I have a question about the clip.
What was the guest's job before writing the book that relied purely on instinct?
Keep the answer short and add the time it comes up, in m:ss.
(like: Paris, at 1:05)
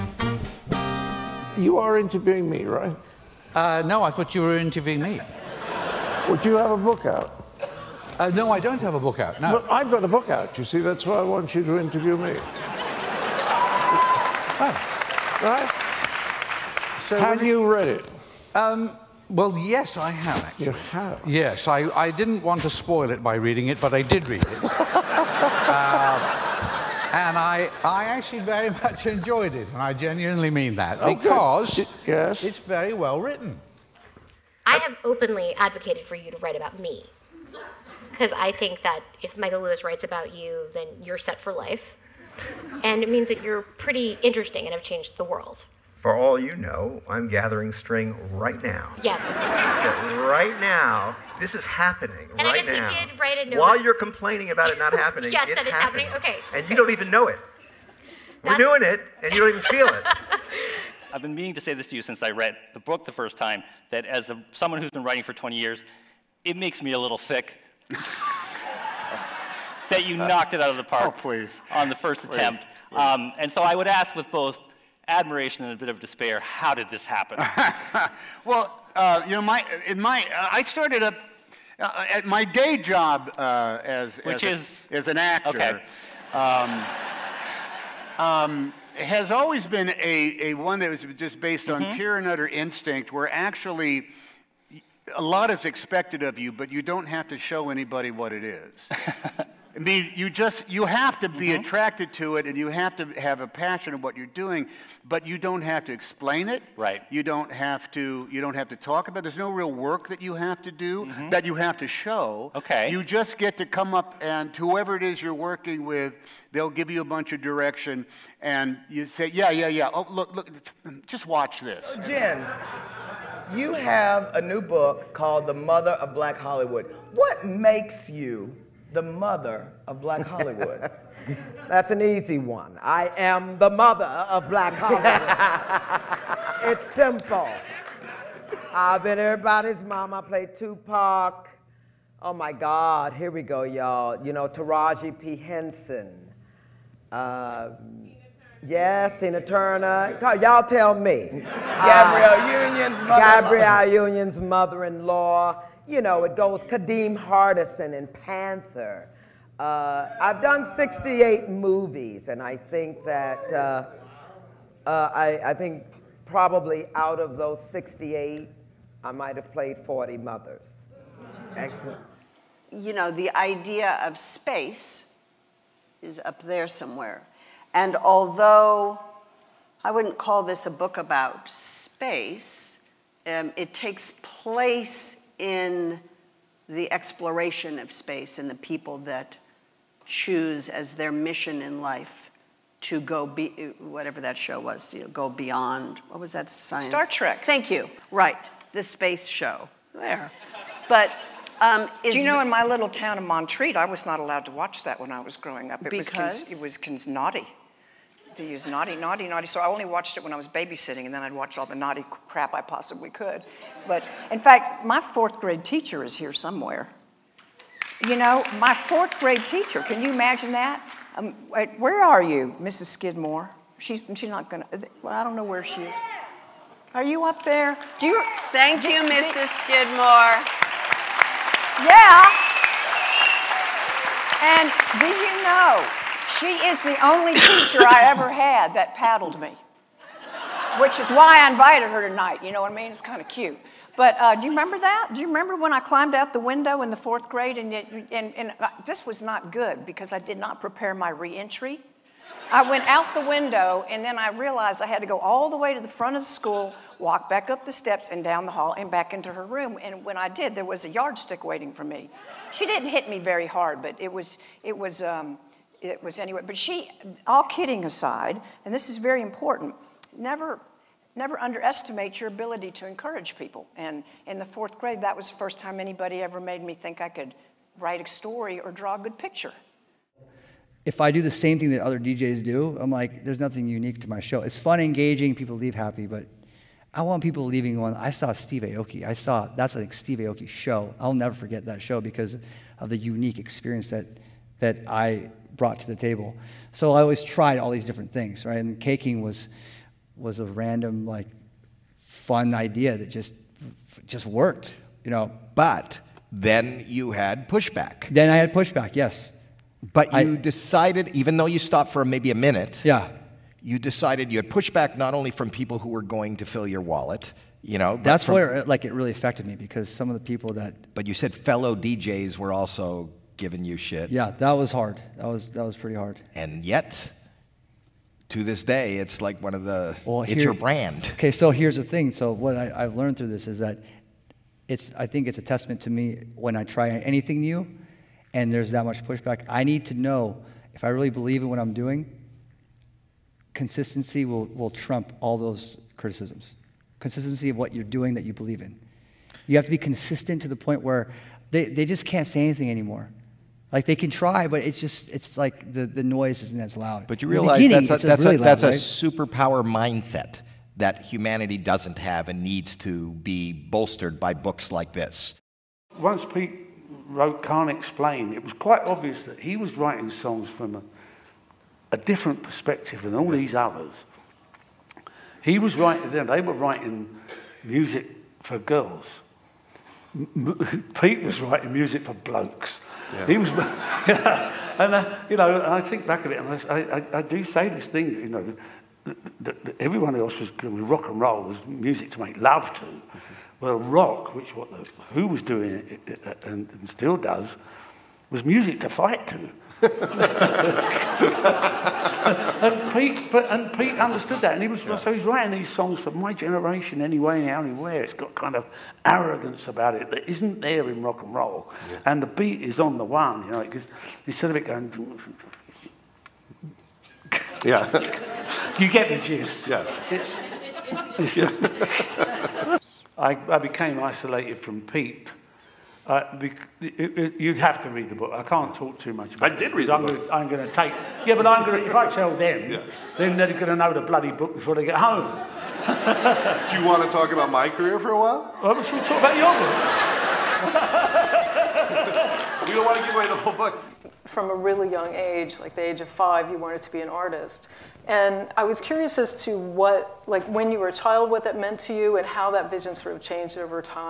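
actor, at 1:25.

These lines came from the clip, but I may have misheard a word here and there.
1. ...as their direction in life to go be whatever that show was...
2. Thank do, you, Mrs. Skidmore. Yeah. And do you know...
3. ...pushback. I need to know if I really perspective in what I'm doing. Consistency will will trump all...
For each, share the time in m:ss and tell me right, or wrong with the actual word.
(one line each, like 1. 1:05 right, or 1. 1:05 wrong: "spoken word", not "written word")
1. 3:10 wrong: "mission", not "direction"
2. 3:48 right
3. 5:39 wrong: "believe", not "perspective".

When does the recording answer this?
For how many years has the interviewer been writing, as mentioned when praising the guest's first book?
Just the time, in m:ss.
1:05.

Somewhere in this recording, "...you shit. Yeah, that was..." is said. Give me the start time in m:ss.
5:23.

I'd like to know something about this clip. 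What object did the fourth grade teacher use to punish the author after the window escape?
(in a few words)
a yardstick.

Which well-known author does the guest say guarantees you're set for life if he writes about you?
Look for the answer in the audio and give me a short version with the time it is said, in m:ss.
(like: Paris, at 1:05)
Michael Lewis, at 0:39.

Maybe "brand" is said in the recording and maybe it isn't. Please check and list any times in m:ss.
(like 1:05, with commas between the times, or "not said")
5:30.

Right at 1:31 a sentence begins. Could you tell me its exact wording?
pure and utter instinct, where actually a lot is expected of you, but you don't have to show anybody what it is.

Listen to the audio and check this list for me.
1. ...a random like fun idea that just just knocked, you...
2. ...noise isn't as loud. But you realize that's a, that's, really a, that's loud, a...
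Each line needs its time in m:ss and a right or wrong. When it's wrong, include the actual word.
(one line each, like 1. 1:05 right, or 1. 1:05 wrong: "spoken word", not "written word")
1. 5:00 wrong: "worked", not "knocked"
2. 5:56 right.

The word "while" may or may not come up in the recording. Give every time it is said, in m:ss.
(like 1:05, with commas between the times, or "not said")
0:53, 7:18.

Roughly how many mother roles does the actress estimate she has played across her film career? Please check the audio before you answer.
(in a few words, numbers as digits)
40.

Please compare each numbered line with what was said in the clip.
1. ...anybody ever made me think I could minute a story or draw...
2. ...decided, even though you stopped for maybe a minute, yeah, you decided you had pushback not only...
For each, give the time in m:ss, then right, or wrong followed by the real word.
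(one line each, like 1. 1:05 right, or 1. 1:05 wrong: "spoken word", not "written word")
1. 4:35 wrong: "write", not "minute"
2. 5:10 right.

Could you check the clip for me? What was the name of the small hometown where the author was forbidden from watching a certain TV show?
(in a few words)
Montreat.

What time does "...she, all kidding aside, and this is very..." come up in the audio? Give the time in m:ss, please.
4:26.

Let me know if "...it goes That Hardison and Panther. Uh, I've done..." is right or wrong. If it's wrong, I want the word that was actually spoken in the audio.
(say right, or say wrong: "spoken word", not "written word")
wrong: "Kadeem", not "That".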